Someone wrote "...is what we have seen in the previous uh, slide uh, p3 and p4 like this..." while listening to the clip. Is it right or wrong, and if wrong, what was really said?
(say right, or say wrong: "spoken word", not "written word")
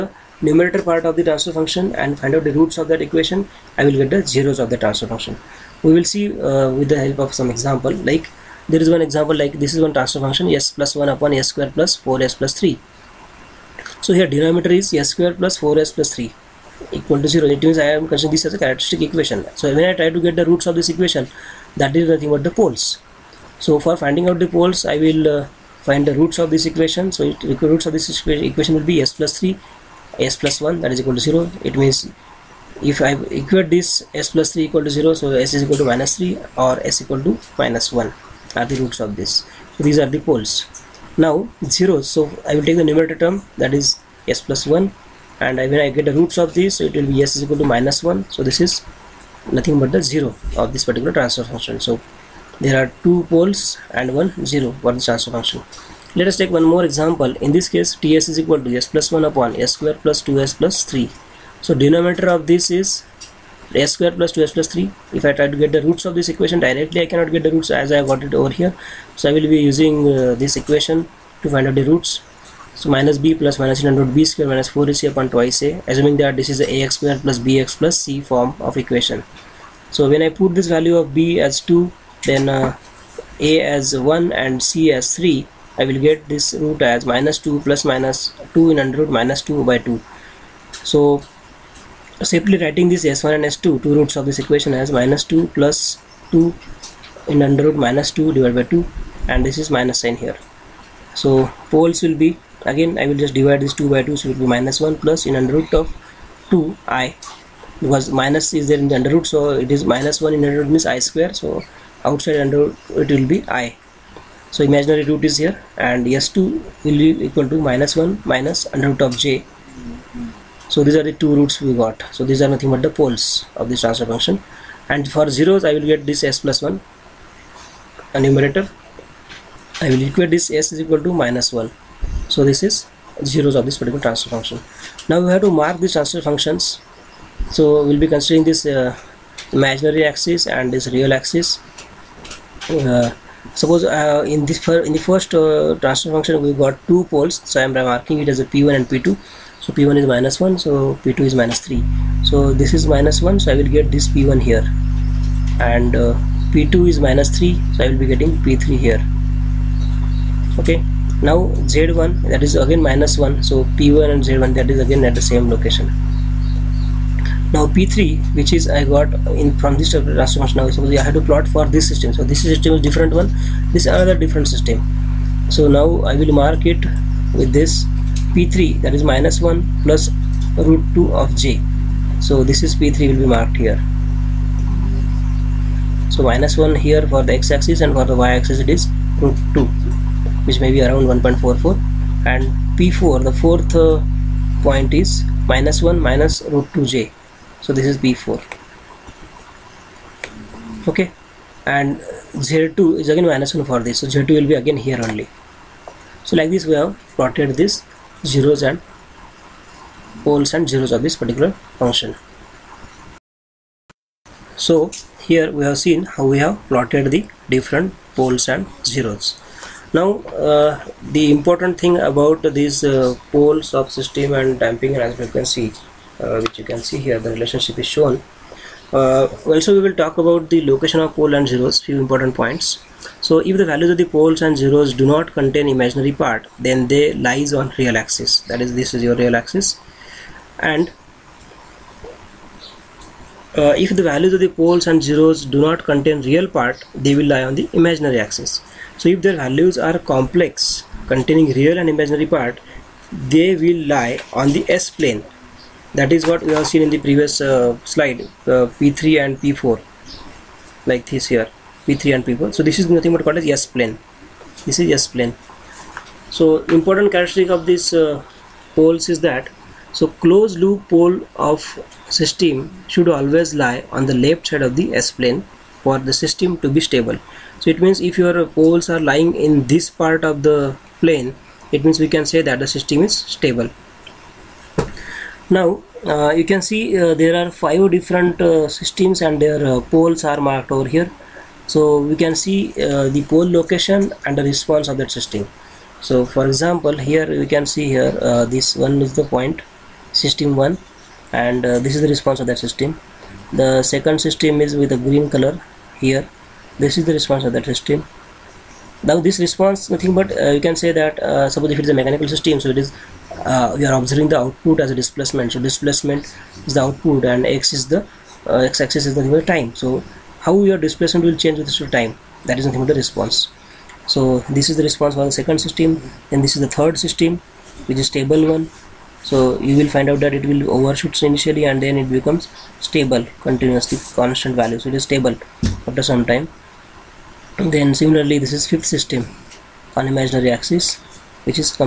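right.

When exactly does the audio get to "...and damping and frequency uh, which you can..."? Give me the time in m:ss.
3:44.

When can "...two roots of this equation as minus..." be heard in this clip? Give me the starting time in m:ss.
1:33.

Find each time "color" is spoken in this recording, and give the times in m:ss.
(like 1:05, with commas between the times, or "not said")
5:05.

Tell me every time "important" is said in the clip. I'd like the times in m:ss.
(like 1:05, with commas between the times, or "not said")
3:41, 3:52, 4:26.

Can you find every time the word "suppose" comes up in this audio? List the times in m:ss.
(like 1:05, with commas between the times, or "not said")
2:23, 2:50, 5:11.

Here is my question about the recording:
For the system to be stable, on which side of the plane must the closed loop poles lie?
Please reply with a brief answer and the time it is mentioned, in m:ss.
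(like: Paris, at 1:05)
left side, at 4:34.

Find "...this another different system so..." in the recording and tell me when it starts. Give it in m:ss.
2:53.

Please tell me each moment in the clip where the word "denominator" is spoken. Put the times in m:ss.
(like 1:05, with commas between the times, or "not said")
0:14, 1:01.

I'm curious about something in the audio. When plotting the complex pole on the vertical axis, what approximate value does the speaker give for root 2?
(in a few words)
1.44.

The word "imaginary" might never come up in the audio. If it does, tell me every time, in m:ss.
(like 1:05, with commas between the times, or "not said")
1:54, 2:19, 3:55, 4:07, 4:11, 5:40.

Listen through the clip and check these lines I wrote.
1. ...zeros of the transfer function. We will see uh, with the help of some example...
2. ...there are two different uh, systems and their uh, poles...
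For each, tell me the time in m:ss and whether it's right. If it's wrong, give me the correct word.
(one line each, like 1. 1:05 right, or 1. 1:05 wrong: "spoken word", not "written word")
1. 0:04 right
2. 4:47 wrong: "five", not "two".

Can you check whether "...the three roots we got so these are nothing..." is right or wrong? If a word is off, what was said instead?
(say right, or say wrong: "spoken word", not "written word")
wrong: "two", not "three".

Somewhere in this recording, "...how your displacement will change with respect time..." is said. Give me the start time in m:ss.
5:20.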